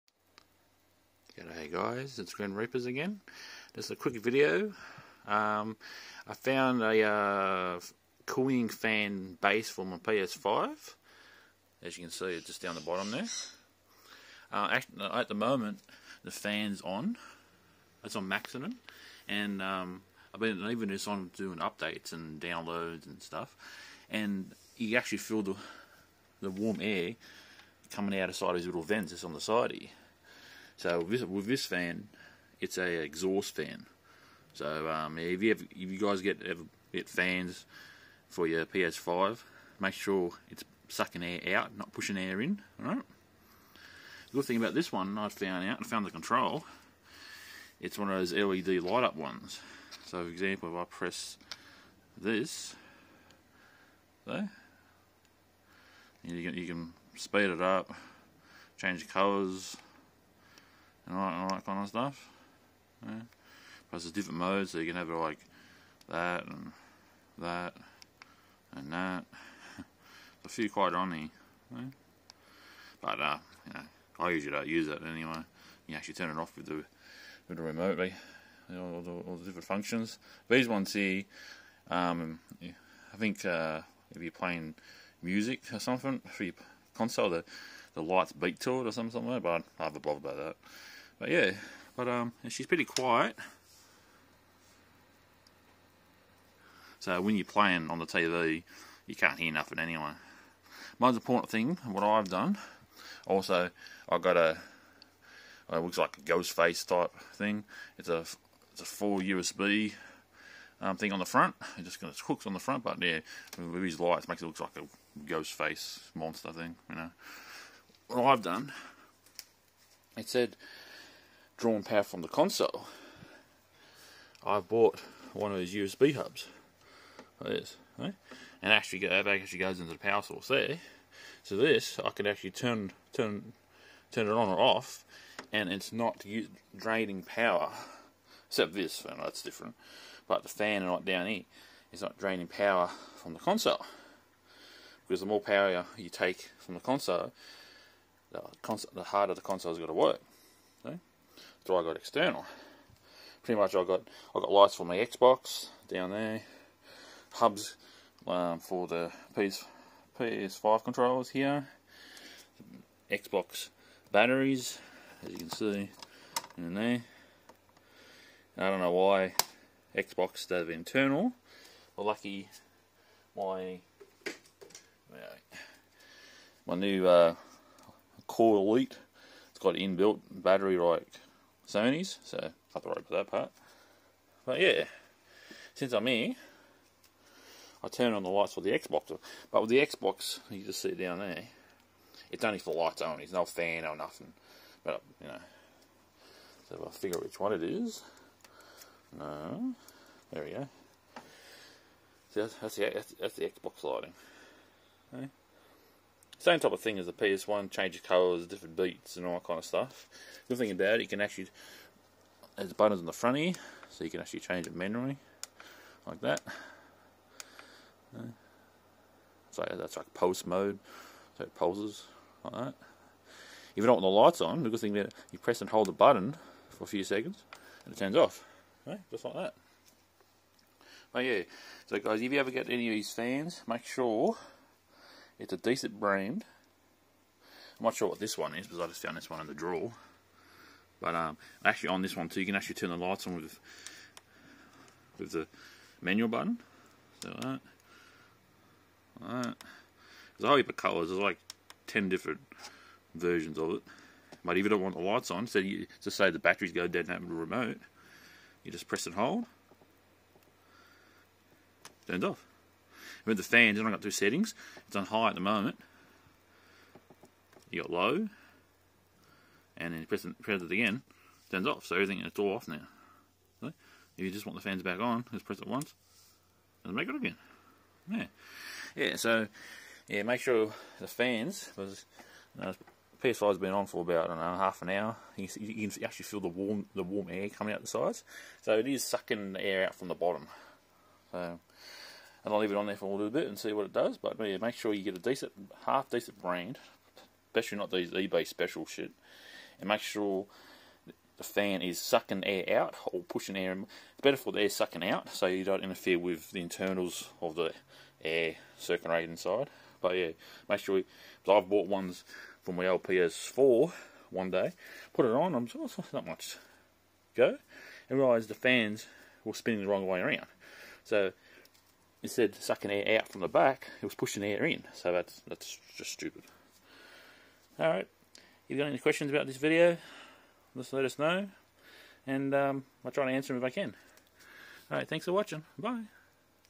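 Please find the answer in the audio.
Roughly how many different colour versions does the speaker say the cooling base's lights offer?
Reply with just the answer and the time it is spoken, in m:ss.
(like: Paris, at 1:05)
10, at 4:11.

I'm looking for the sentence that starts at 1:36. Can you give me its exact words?
So when you're playing on the TV, you can't hear nothing anyway.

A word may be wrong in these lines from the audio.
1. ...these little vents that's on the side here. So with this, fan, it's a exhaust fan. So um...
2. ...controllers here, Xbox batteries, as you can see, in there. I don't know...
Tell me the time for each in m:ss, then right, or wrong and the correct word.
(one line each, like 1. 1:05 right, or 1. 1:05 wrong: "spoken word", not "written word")
1. 0:28 right
2. 2:40 right.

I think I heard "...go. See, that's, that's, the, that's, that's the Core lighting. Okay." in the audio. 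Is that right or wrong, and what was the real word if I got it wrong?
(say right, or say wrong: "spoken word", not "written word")
wrong: "Xbox", not "Core".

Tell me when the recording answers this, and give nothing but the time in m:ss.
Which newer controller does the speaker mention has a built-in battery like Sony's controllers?
2:58.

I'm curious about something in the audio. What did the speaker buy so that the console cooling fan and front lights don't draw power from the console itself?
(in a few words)
USB hubs.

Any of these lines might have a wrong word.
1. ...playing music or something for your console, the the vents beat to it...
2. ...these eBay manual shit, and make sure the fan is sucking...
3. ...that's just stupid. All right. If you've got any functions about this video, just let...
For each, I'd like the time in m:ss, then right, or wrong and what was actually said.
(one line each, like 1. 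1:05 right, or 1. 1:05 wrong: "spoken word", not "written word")
1. 1:24 wrong: "lights", not "vents"
2. 4:57 wrong: "special", not "manual"
3. 5:25 wrong: "questions", not "functions".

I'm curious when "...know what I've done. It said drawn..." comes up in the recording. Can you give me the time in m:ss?
1:56.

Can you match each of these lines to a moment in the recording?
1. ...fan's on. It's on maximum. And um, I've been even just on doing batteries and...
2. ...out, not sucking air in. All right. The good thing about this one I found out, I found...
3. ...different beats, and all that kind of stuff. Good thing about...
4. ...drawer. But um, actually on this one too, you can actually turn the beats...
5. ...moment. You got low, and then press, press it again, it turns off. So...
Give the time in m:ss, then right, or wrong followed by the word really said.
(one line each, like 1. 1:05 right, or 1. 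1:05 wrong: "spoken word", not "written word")
1. 0:16 wrong: "updates", not "batteries"
2. 0:41 wrong: "pushing", not "sucking"
3. 3:28 right
4. 3:59 wrong: "lights", not "beats"
5. 4:25 right.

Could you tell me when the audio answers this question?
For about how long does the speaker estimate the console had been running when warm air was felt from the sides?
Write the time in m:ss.
4:44.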